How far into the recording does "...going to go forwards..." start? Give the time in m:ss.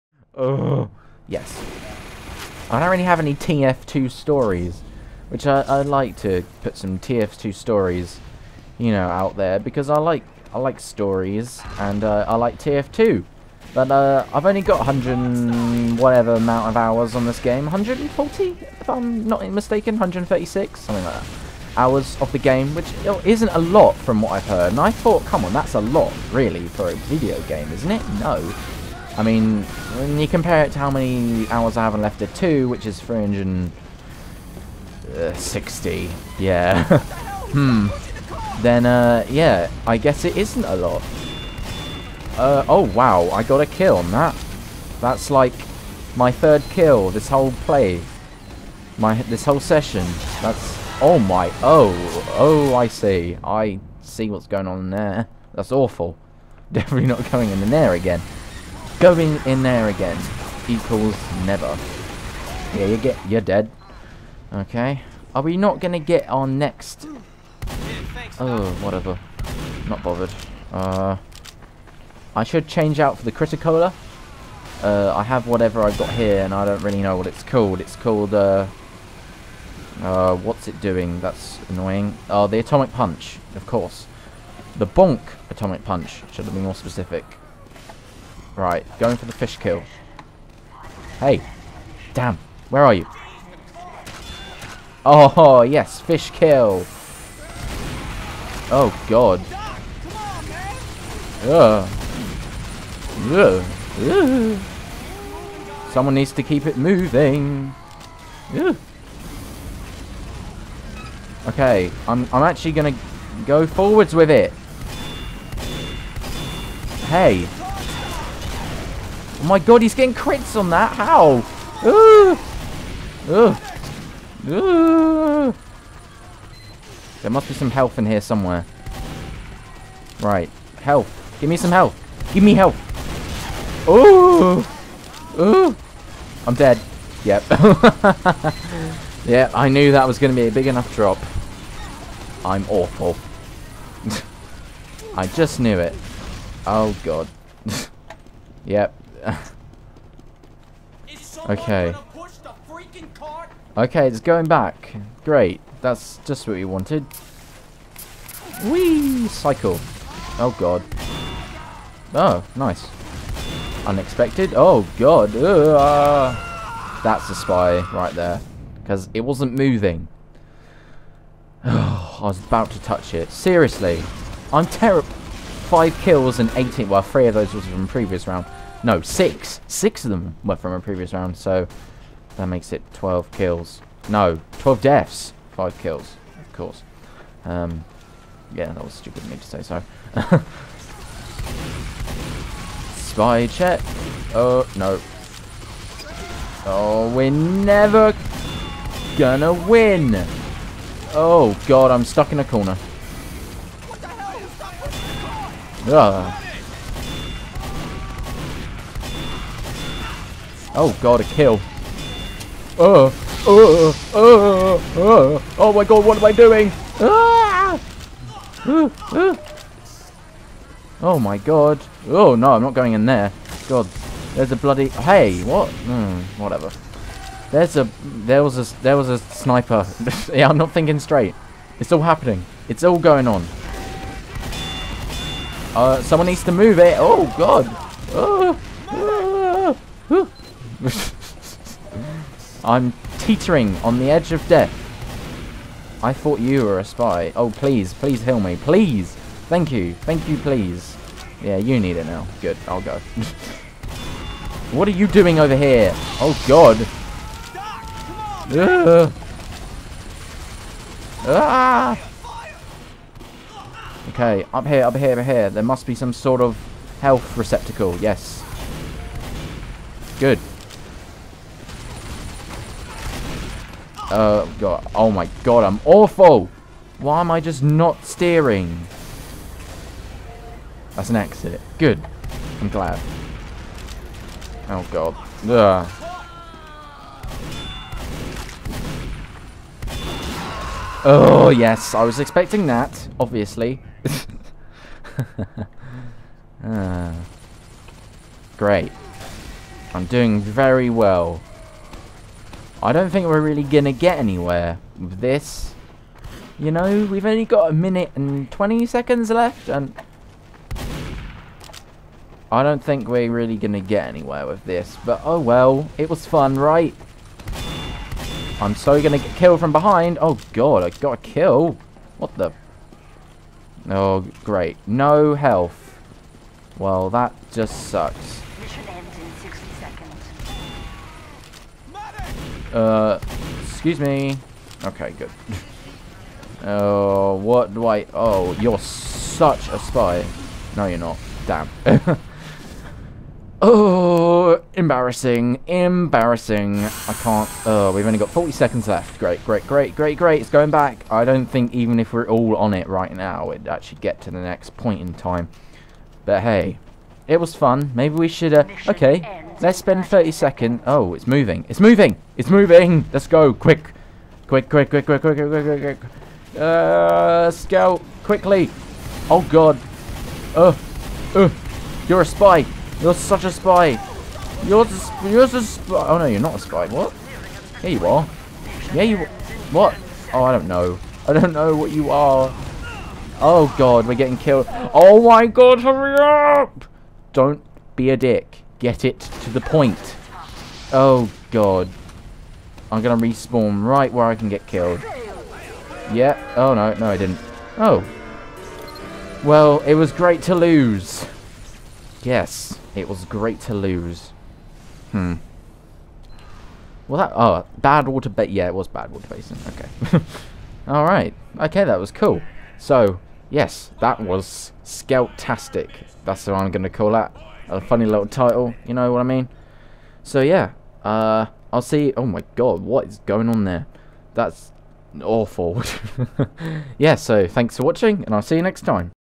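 1:52.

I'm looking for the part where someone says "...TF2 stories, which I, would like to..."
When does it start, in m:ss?
0:03.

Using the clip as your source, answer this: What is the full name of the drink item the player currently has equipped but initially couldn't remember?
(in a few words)
Bonk Atomic Punch.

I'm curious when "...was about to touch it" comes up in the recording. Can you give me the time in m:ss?
2:52.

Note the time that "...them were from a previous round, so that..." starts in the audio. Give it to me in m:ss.
3:00.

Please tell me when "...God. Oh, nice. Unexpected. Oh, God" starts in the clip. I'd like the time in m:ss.
2:40.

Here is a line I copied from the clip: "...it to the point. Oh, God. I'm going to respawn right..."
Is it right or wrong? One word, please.
right.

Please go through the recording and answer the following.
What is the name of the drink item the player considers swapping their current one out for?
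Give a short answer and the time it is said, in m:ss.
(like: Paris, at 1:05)
Crit-a-Cola, at 1:13.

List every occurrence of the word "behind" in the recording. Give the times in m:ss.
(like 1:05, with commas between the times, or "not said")
5:19.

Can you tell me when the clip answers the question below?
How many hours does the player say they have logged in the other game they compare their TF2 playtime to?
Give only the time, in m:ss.
0:32.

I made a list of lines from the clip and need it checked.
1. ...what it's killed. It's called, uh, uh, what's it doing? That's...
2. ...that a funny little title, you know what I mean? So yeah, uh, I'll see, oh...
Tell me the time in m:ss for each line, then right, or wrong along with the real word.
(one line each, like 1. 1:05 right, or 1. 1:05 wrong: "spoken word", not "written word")
1. 1:17 wrong: "called", not "killed"
2. 6:57 right.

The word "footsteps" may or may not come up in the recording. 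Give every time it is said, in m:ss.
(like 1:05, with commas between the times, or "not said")
not said.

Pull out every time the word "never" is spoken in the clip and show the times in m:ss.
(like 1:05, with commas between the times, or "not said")
1:01, 3:17.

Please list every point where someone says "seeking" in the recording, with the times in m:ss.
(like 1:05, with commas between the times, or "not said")
not said.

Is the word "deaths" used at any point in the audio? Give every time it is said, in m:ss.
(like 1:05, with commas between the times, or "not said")
3:04, 4:04.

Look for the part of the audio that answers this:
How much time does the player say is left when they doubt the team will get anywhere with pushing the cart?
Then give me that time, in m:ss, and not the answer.
5:07.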